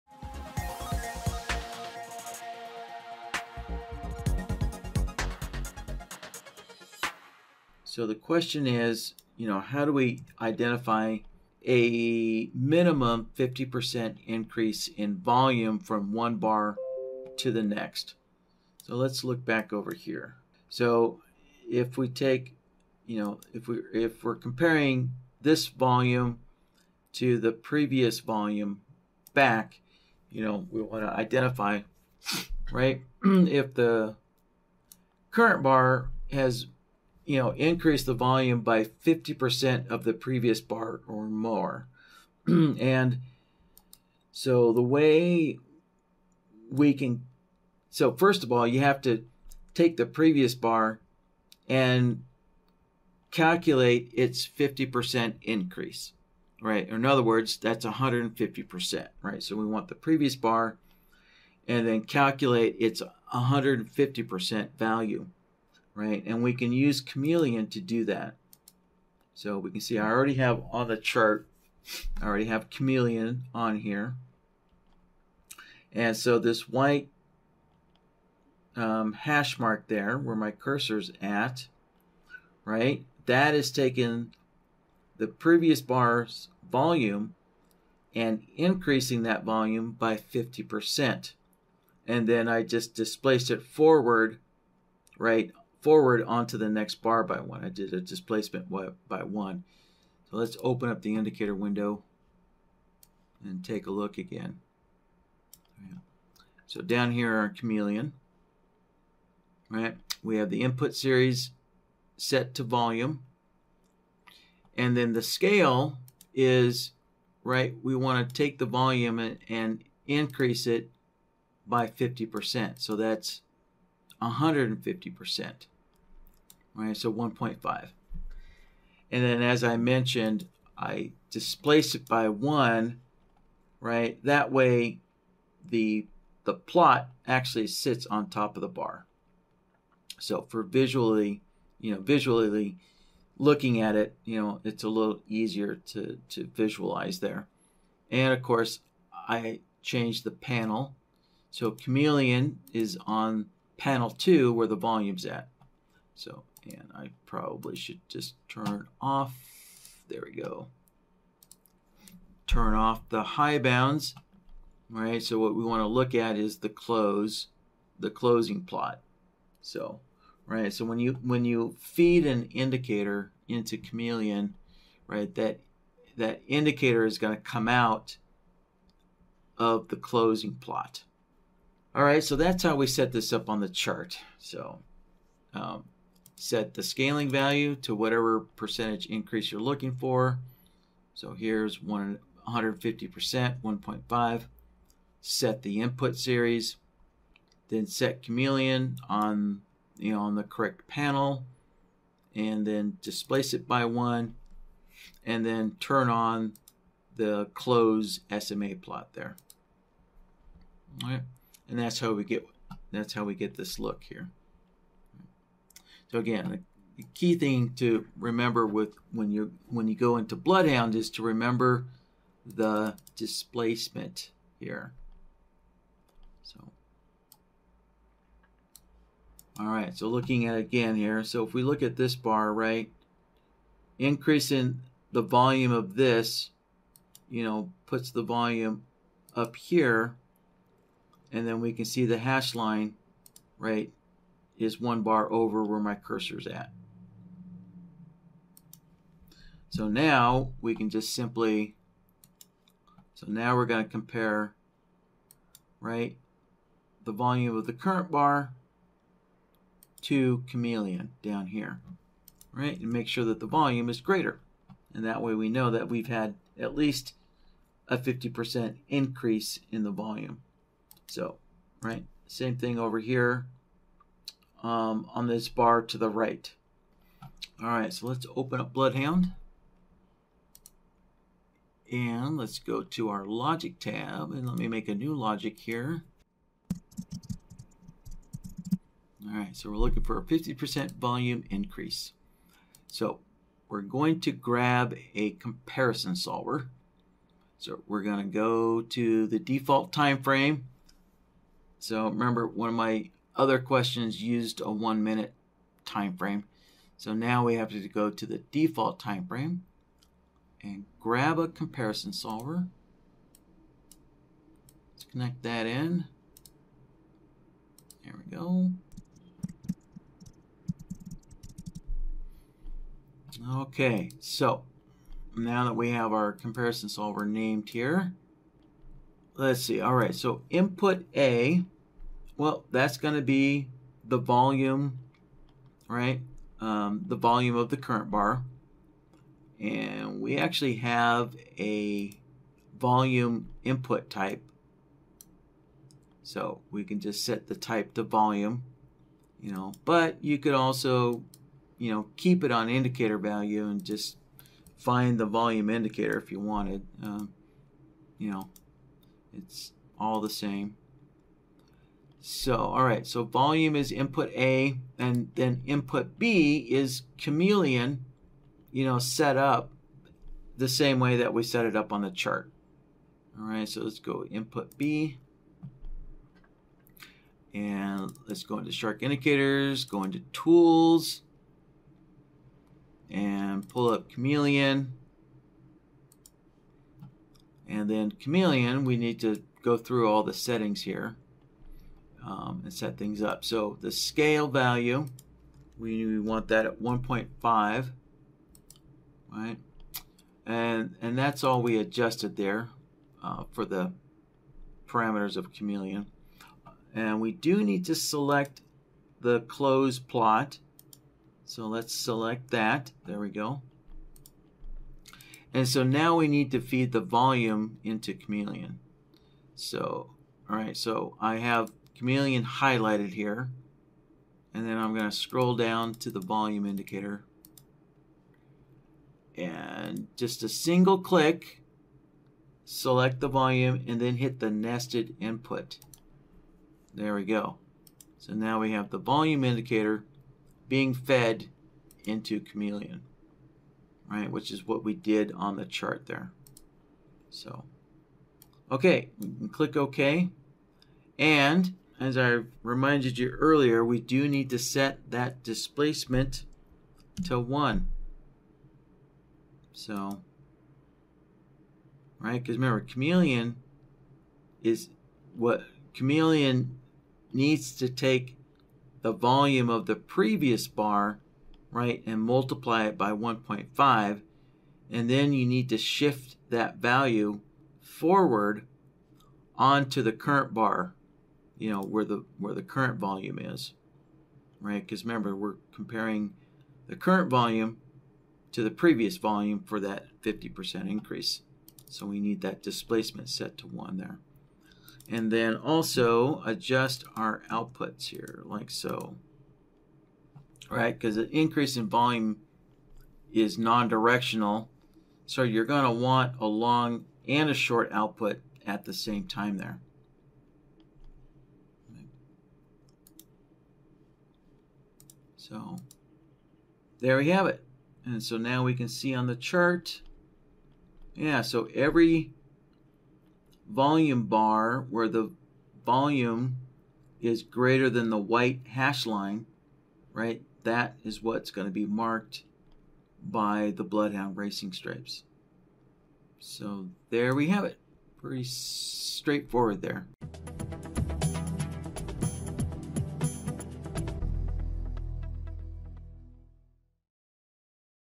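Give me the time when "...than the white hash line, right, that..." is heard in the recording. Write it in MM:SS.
08:47.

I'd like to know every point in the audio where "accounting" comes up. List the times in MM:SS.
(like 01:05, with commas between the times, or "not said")
not said.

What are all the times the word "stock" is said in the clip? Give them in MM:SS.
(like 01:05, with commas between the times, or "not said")
not said.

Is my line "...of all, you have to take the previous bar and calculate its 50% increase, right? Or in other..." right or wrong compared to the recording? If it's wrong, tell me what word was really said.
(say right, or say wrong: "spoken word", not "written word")
right.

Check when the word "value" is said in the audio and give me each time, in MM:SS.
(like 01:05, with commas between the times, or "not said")
01:04, 03:07, 05:53, 06:34, 07:56.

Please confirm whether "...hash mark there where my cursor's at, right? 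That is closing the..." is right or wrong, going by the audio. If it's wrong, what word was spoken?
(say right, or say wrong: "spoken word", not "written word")
wrong: "taking", not "closing".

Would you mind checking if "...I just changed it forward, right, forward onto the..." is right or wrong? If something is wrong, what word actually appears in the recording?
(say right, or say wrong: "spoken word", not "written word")
wrong: "displaced", not "changed".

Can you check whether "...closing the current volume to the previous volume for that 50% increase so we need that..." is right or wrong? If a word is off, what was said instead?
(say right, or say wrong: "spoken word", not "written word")
wrong: "comparing", not "closing".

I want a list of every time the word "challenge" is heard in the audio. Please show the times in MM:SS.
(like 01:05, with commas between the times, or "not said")
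not said.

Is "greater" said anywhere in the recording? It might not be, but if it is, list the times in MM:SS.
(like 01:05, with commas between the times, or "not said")
04:24, 08:47.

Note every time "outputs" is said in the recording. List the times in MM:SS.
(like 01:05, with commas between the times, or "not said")
08:17, 08:27.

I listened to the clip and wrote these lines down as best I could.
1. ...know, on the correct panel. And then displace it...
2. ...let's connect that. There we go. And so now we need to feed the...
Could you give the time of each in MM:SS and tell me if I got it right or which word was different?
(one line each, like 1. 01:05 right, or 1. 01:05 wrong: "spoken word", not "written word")
1. 03:20 right
2. 06:51 wrong: "select", not "connect".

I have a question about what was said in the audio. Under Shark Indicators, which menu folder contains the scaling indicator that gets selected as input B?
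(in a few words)
Tools.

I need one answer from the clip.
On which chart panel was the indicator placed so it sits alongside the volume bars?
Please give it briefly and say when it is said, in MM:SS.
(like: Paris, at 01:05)
panel two, at 02:33.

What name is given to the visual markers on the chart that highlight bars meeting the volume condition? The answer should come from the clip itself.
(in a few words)
Racing Stripes.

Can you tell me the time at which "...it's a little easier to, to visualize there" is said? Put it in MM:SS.
02:24.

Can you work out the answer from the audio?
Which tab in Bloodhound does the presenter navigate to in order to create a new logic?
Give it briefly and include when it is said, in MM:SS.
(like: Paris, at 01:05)
logic tab, at 04:43.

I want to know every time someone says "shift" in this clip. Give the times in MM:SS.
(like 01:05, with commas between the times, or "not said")
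07:55.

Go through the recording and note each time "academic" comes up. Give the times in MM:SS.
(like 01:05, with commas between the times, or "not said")
not said.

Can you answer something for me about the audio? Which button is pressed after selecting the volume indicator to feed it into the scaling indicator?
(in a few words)
nested input.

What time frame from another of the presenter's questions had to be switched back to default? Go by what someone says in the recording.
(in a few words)
one minute.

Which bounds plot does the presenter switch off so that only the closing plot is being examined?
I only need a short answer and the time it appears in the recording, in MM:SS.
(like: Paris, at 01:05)
high bounds, at 02:43.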